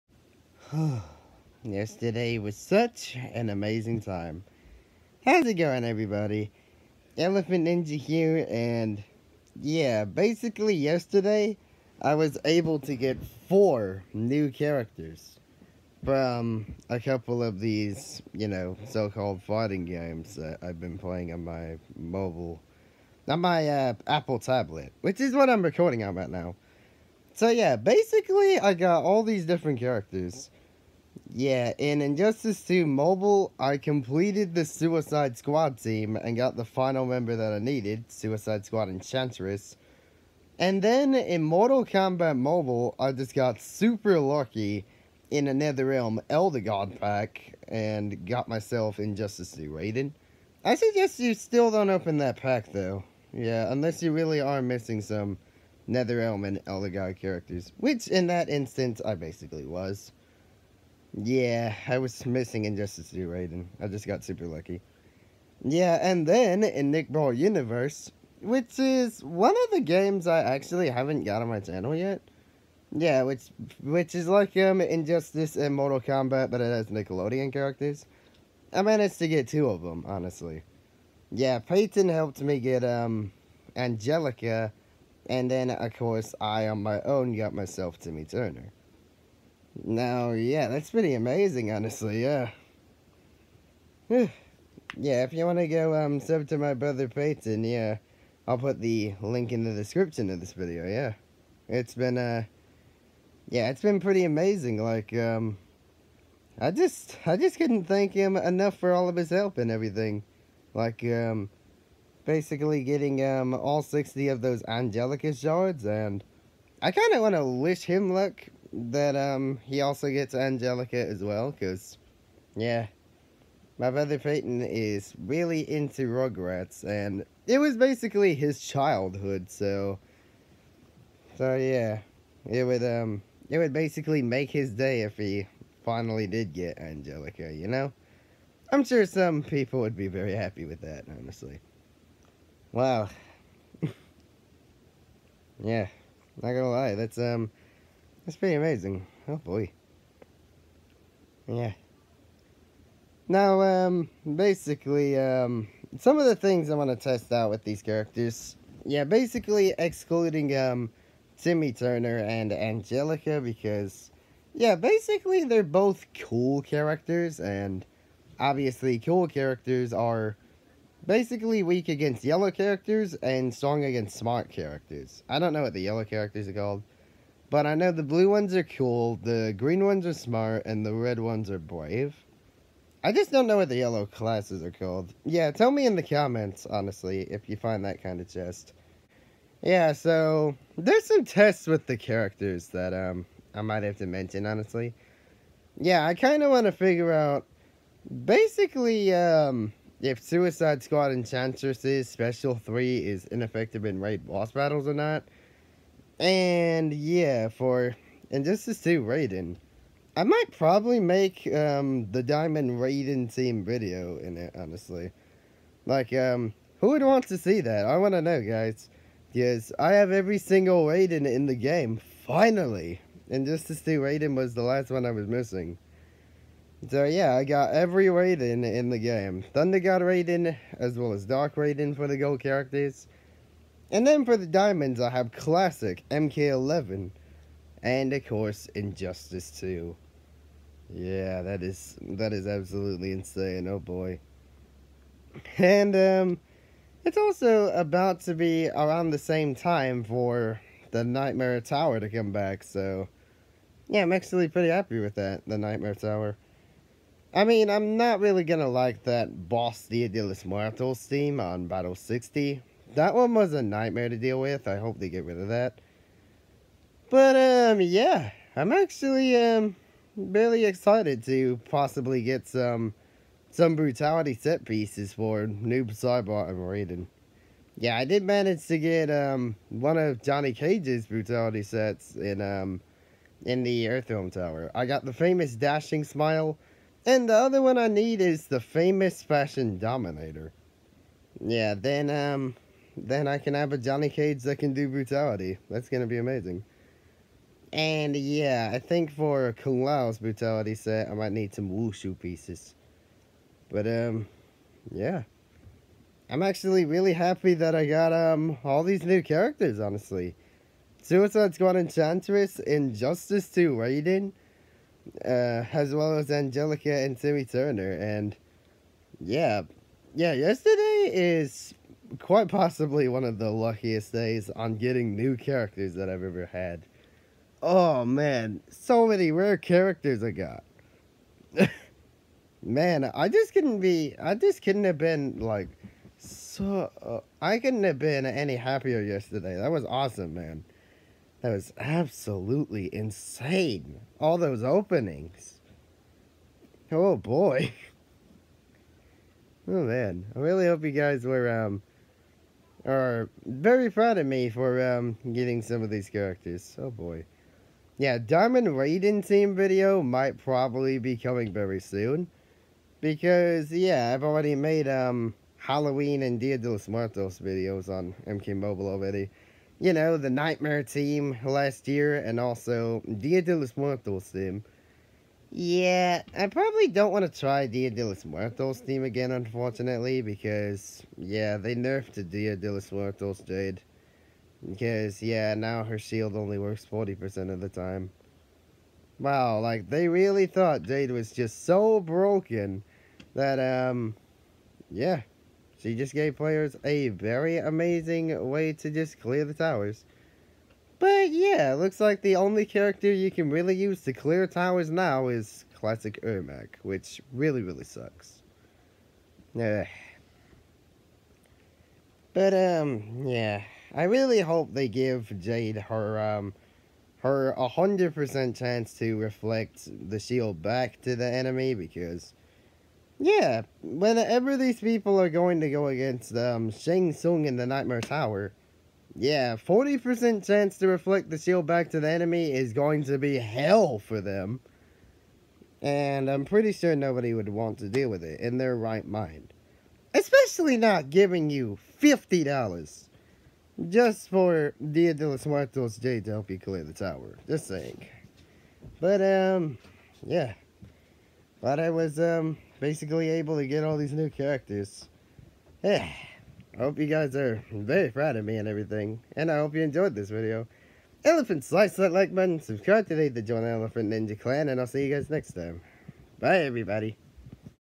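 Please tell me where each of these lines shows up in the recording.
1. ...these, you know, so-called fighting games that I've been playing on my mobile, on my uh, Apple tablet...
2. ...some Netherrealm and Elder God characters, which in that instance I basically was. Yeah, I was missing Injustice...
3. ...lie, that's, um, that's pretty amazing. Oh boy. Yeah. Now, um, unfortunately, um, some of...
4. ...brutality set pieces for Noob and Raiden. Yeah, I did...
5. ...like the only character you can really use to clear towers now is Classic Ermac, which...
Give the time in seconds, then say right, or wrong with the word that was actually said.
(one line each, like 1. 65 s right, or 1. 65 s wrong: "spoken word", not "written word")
1. 17 s right
2. 55 s right
3. 146 s wrong: "basically", not "unfortunately"
4. 273 s right
5. 401 s right.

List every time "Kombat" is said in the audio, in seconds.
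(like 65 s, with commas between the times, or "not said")
41 s, 76 s.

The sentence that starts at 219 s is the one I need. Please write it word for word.
Yes, I have every single Raiden in the game, finally.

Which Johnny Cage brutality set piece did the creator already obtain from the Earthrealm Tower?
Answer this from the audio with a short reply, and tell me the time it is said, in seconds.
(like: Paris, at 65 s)
Famous Dashing Smile, at 285 s.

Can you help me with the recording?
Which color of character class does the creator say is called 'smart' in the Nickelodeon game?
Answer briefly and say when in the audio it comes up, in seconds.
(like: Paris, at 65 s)
Green, at 179 s.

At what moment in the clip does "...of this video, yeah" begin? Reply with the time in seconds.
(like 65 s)
100 s.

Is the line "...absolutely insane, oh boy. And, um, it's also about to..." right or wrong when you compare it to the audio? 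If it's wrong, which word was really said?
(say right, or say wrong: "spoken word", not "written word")
right.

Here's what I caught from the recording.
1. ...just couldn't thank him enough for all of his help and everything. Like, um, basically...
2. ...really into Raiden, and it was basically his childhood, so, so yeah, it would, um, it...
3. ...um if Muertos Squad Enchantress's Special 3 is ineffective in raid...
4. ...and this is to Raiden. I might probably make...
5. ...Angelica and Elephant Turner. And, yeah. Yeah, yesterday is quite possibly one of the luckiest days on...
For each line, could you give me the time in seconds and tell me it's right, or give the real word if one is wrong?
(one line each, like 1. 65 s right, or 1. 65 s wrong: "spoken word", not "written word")
1. 107 s right
2. 125 s wrong: "Rugrats", not "Raiden"
3. 199 s wrong: "Suicide", not "Muertos"
4. 208 s right
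5. 316 s wrong: "Timmy", not "Elephant".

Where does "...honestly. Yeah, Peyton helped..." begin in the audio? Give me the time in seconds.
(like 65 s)
80 s.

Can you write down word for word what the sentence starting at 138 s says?
I'm sure some people would be very happy with that, honestly.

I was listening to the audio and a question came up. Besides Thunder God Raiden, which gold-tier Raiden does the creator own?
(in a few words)
Dark Raiden.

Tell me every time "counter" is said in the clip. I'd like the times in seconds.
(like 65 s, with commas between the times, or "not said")
not said.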